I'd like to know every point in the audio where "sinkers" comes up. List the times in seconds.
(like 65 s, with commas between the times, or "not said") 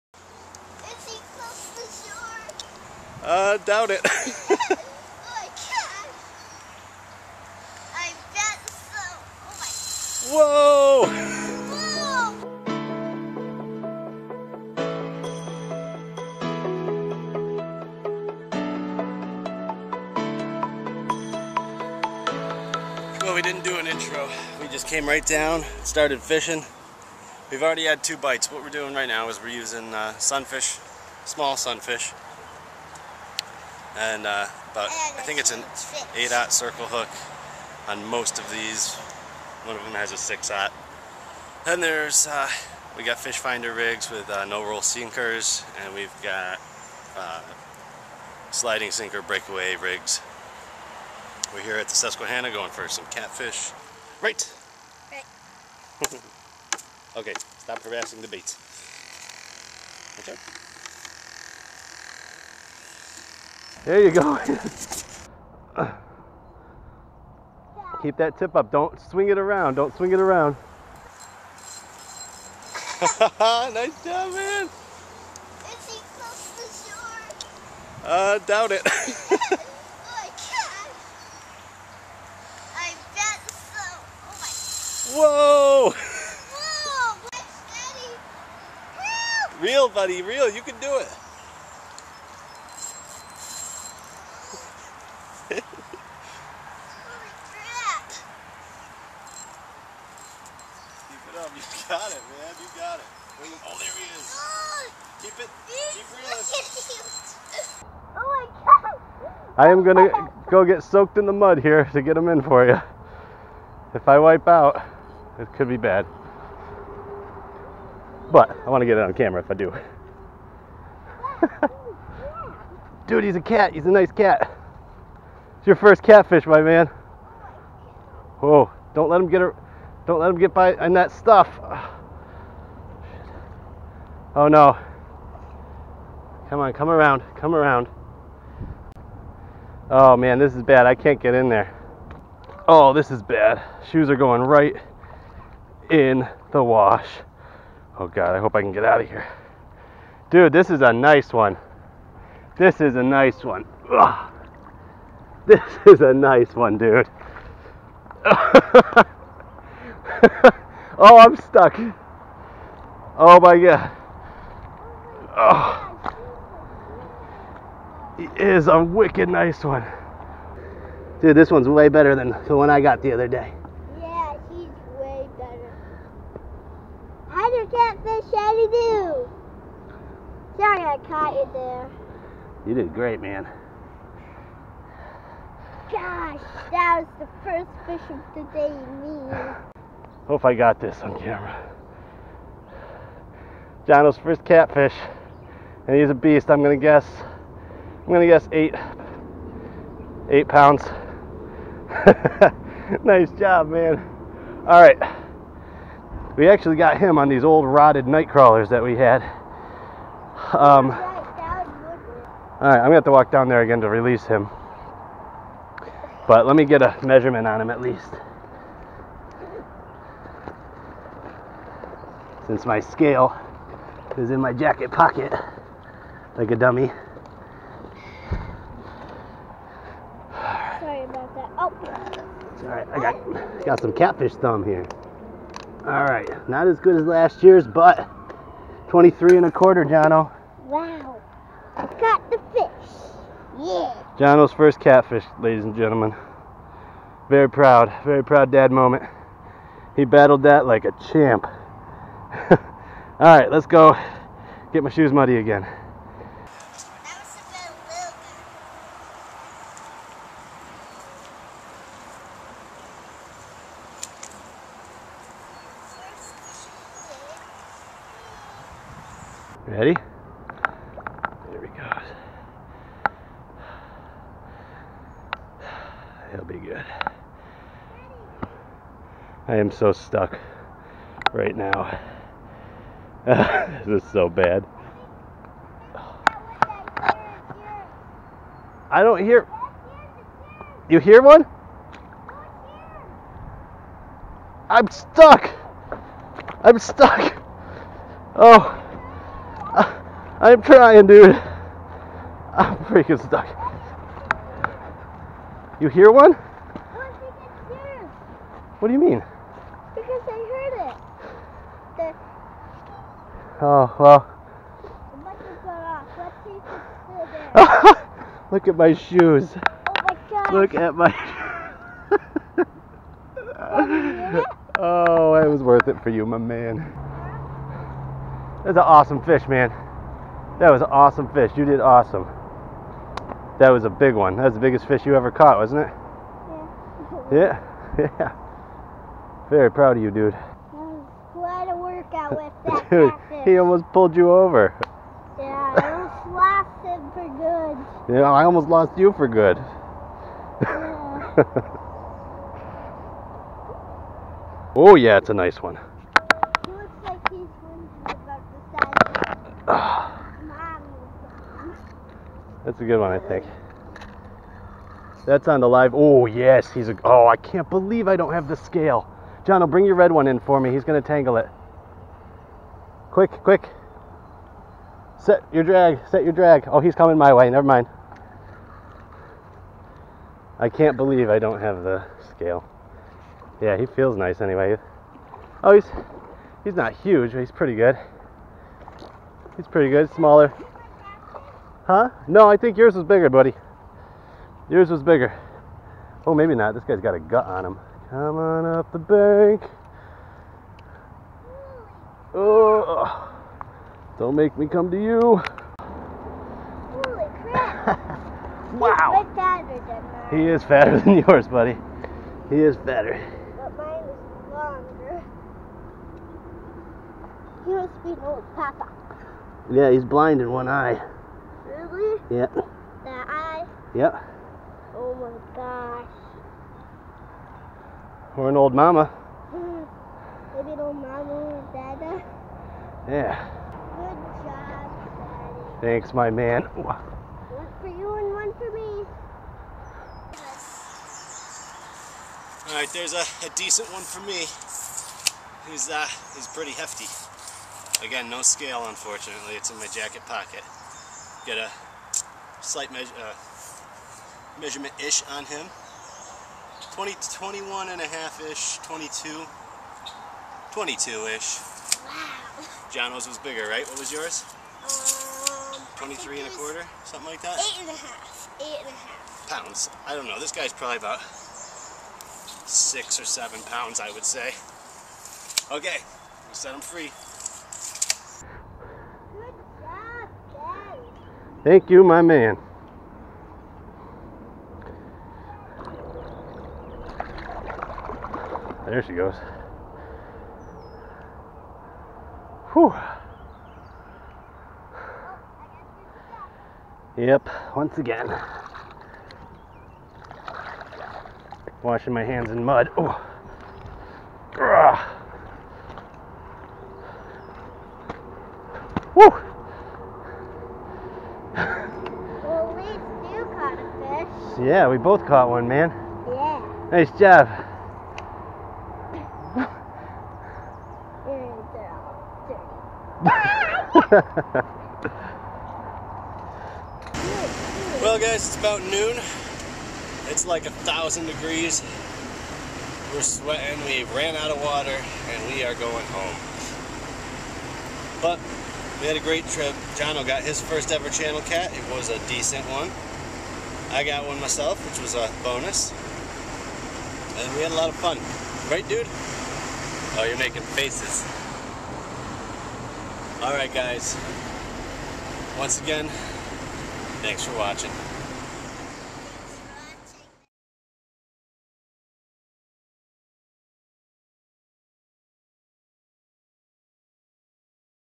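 44 s, 48 s.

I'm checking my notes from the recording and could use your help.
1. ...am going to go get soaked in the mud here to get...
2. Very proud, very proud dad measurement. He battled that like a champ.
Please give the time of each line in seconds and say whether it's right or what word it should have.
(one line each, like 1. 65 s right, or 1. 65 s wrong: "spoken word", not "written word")
1. 109 s right
2. 247 s wrong: "moment", not "measurement".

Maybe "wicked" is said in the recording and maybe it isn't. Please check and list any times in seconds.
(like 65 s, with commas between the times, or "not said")
168 s.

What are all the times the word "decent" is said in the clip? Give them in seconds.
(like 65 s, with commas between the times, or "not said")
443 s, 542 s.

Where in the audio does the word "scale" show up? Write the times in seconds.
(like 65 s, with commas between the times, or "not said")
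222 s, 368 s, 382 s, 448 s.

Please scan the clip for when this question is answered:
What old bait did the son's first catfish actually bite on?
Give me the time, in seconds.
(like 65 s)
207 s.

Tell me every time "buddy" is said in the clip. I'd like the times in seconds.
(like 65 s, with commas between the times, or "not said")
89 s, 393 s, 411 s.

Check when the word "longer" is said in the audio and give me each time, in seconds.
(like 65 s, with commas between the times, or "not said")
414 s.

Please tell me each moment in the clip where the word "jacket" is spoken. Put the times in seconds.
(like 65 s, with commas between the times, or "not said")
224 s, 449 s.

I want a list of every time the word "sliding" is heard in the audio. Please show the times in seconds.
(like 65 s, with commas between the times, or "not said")
48 s.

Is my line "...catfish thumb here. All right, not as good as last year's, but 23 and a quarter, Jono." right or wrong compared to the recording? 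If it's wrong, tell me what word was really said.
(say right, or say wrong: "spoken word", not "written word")
right.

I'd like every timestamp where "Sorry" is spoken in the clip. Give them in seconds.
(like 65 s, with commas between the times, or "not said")
180 s, 230 s.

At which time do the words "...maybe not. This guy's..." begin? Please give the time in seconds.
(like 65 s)
396 s.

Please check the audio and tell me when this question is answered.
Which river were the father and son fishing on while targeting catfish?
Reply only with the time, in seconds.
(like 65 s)
51 s.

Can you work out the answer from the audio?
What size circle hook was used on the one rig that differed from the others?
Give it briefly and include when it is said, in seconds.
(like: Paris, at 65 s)
6-aught, at 40 s.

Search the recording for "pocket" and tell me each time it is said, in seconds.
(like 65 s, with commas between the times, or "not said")
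224 s, 450 s.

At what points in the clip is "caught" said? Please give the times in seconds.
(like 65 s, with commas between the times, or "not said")
181 s, 335 s, 515 s.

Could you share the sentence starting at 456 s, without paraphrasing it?
20, 21 and a half-ish, 22, 22-ish.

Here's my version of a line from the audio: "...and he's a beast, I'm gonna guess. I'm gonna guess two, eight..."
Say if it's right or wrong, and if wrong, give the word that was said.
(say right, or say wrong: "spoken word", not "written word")
wrong: "eight", not "two".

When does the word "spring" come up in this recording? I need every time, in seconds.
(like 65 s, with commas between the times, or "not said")
not said.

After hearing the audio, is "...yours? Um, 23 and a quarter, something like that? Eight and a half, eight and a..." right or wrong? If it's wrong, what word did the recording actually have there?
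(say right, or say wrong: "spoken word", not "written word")
right.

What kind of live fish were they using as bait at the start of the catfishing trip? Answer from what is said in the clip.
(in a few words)
small sunfish.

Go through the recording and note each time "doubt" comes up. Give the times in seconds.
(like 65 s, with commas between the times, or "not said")
3 s, 78 s.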